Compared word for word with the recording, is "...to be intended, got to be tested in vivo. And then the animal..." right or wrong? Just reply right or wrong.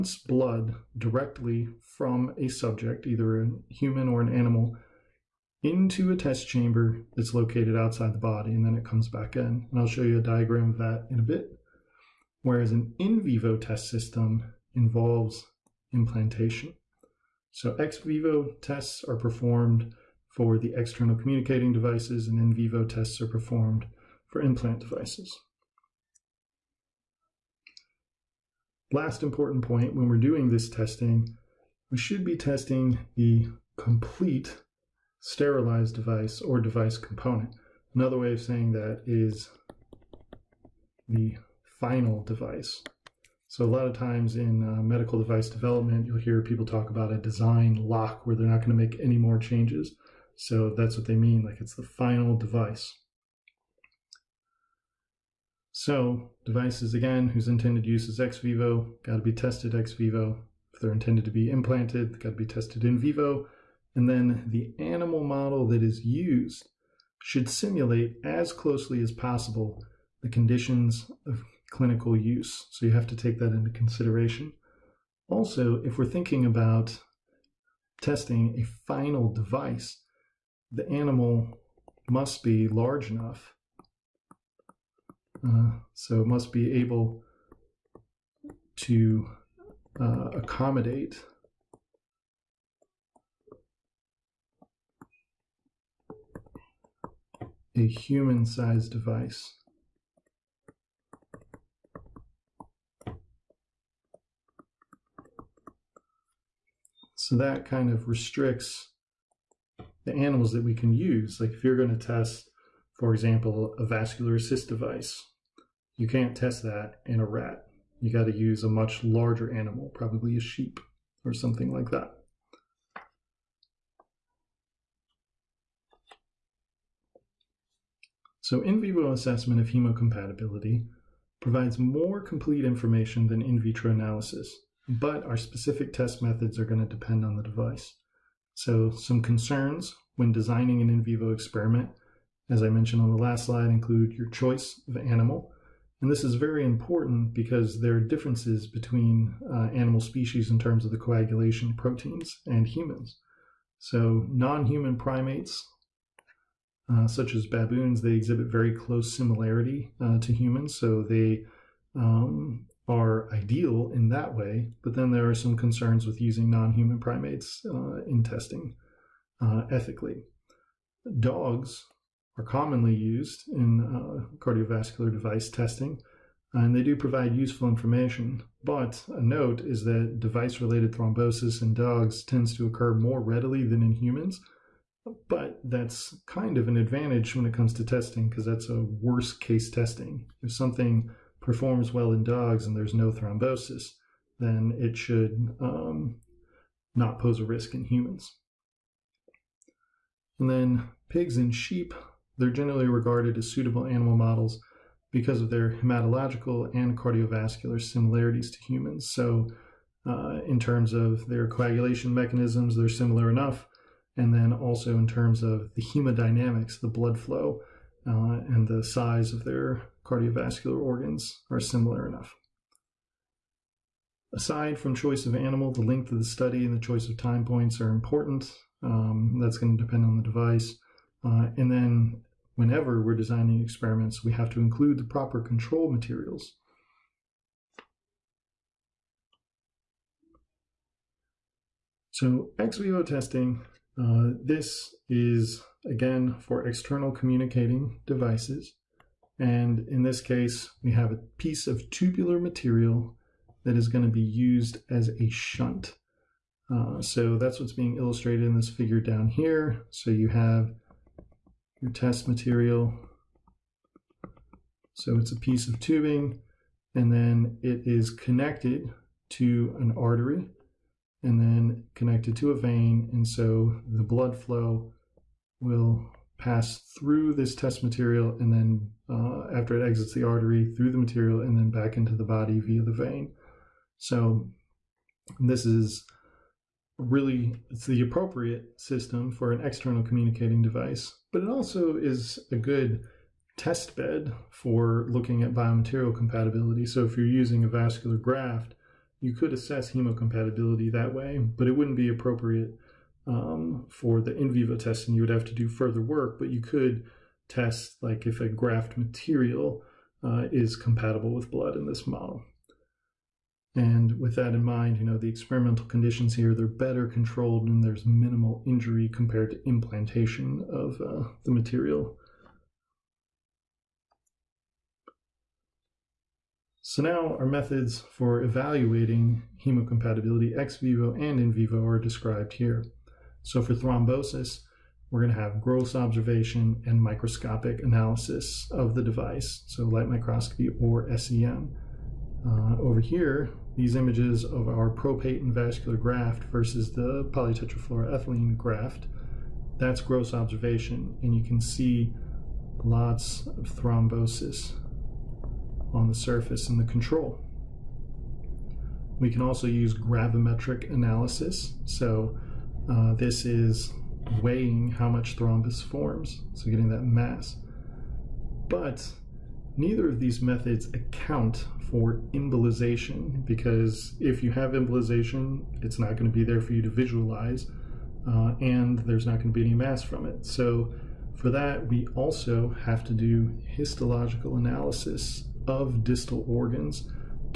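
wrong.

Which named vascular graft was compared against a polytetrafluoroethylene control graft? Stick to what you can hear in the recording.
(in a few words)
Propaten.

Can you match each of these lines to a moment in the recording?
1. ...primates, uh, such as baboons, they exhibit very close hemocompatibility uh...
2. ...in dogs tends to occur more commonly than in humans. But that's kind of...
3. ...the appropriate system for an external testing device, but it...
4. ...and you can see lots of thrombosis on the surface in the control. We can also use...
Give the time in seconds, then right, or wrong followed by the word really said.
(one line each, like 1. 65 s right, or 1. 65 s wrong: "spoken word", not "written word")
1. 154 s wrong: "similarity", not "hemocompatibility"
2. 181 s wrong: "readily", not "commonly"
3. 287 s wrong: "communicating", not "testing"
4. 351 s right.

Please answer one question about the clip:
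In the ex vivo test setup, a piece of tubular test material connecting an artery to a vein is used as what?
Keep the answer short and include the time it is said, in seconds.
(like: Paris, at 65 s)
A shunt, at 255 s.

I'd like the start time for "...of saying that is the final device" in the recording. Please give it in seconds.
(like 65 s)
38 s.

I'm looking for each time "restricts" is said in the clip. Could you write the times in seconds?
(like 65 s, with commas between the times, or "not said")
108 s.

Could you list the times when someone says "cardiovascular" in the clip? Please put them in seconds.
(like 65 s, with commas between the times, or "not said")
174 s, 206 s, 220 s.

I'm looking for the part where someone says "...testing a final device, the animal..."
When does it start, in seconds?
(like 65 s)
78 s.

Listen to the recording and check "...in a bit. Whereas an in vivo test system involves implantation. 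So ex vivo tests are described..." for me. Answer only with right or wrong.
wrong.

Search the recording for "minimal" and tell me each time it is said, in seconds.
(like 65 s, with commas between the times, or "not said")
318 s.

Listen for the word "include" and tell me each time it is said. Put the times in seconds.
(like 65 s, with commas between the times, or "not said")
143 s, 234 s.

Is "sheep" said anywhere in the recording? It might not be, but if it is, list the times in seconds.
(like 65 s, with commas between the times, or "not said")
120 s, 201 s.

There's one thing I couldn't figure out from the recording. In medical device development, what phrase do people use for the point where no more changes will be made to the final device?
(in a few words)
Design lock.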